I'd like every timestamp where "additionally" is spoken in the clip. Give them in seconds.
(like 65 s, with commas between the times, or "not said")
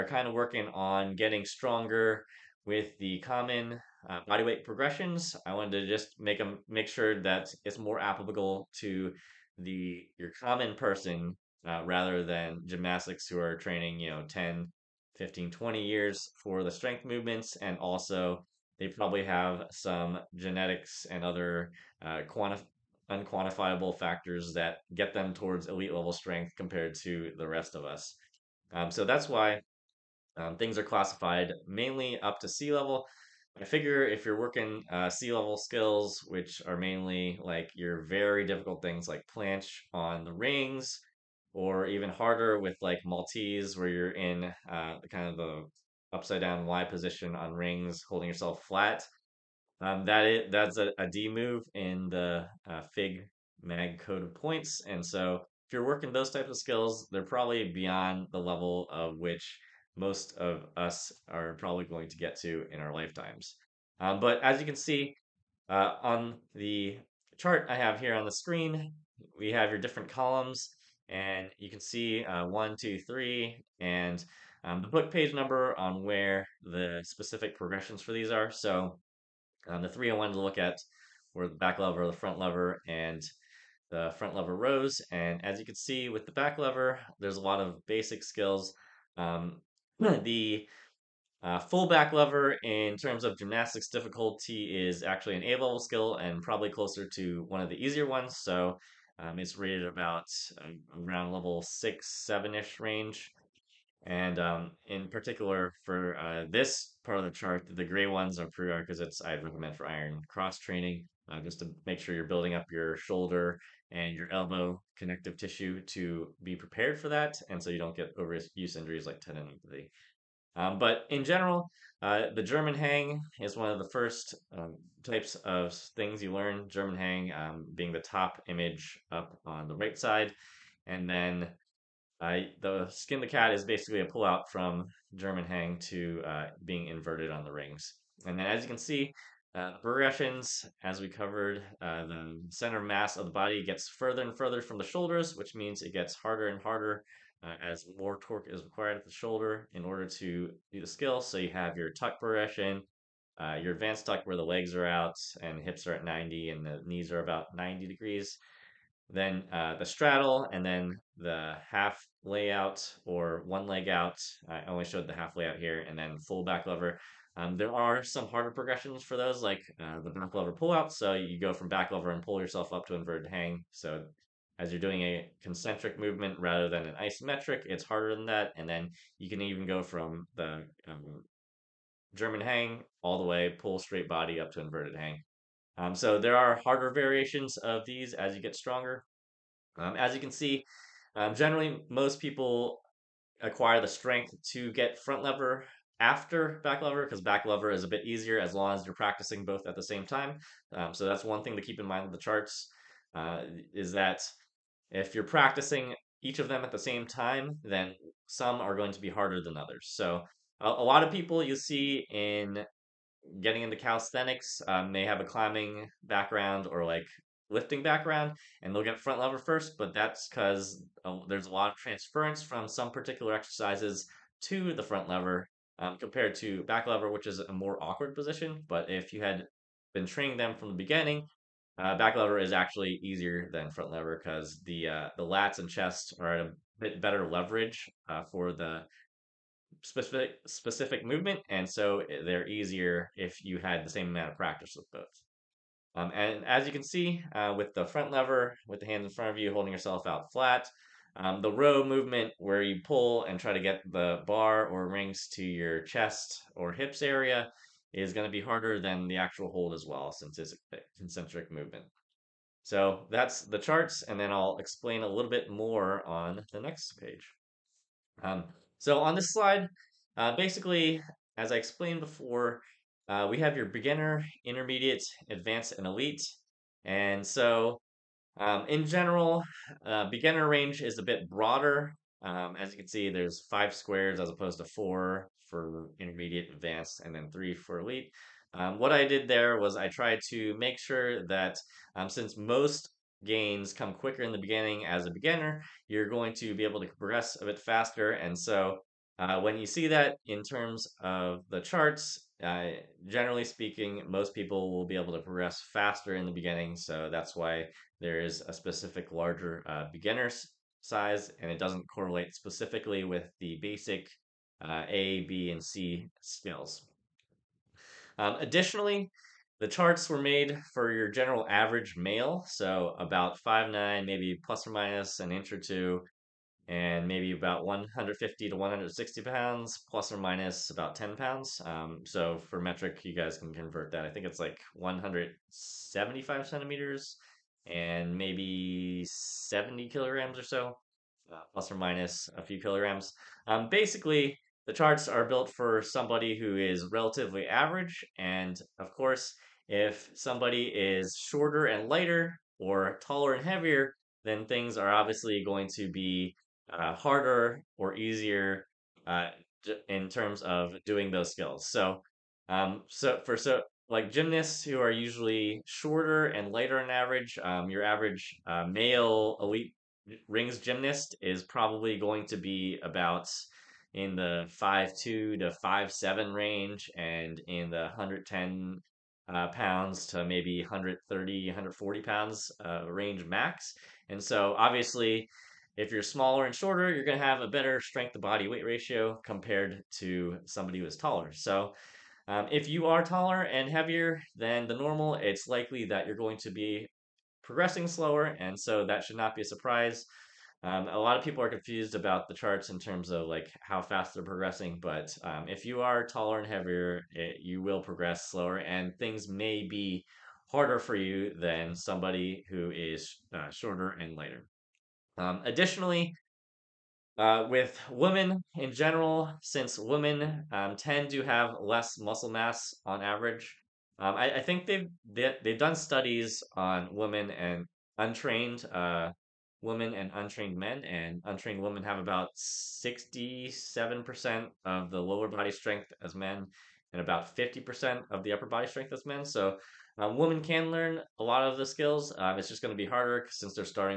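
318 s, 415 s.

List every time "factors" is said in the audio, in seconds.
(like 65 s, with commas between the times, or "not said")
23 s.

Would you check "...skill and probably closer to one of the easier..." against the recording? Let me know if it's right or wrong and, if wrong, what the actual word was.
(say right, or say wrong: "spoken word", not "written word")
right.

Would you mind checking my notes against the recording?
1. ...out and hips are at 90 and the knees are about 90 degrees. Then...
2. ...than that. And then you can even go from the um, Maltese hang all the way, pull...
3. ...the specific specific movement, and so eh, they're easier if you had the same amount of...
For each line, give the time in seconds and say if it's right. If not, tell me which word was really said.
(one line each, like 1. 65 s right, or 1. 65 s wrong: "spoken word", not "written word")
1. 154 s right
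2. 178 s wrong: "German", not "Maltese"
3. 238 s right.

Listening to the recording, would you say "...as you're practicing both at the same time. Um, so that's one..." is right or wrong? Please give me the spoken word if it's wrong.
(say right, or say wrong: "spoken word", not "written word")
right.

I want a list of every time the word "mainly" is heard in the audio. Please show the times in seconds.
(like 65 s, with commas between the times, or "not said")
31 s, 36 s.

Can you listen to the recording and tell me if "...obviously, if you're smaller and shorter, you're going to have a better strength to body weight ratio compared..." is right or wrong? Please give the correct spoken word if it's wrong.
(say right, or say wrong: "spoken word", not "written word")
right.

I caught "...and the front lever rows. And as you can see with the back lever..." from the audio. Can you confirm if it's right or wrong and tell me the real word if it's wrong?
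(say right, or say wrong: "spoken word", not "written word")
right.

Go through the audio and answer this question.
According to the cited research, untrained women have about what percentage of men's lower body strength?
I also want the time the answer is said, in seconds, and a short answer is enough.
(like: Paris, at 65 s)
67%, at 432 s.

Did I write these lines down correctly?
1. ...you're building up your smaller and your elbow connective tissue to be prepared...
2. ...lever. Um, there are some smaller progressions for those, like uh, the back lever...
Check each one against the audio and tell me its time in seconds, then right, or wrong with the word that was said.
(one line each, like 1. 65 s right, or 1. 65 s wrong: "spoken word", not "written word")
1. 112 s wrong: "shoulder", not "smaller"
2. 166 s wrong: "harder", not "smaller".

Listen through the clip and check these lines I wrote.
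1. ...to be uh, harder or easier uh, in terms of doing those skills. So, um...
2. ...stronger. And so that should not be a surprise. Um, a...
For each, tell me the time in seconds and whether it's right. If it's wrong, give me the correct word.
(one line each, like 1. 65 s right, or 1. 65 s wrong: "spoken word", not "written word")
1. 355 s right
2. 397 s wrong: "slower", not "stronger".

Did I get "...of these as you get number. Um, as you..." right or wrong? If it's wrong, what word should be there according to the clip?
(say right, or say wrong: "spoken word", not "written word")
wrong: "stronger", not "number".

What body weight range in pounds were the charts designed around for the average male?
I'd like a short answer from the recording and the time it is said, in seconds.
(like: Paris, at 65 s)
150 to 160 pounds, at 327 s.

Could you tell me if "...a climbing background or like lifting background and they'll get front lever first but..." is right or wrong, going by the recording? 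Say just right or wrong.
right.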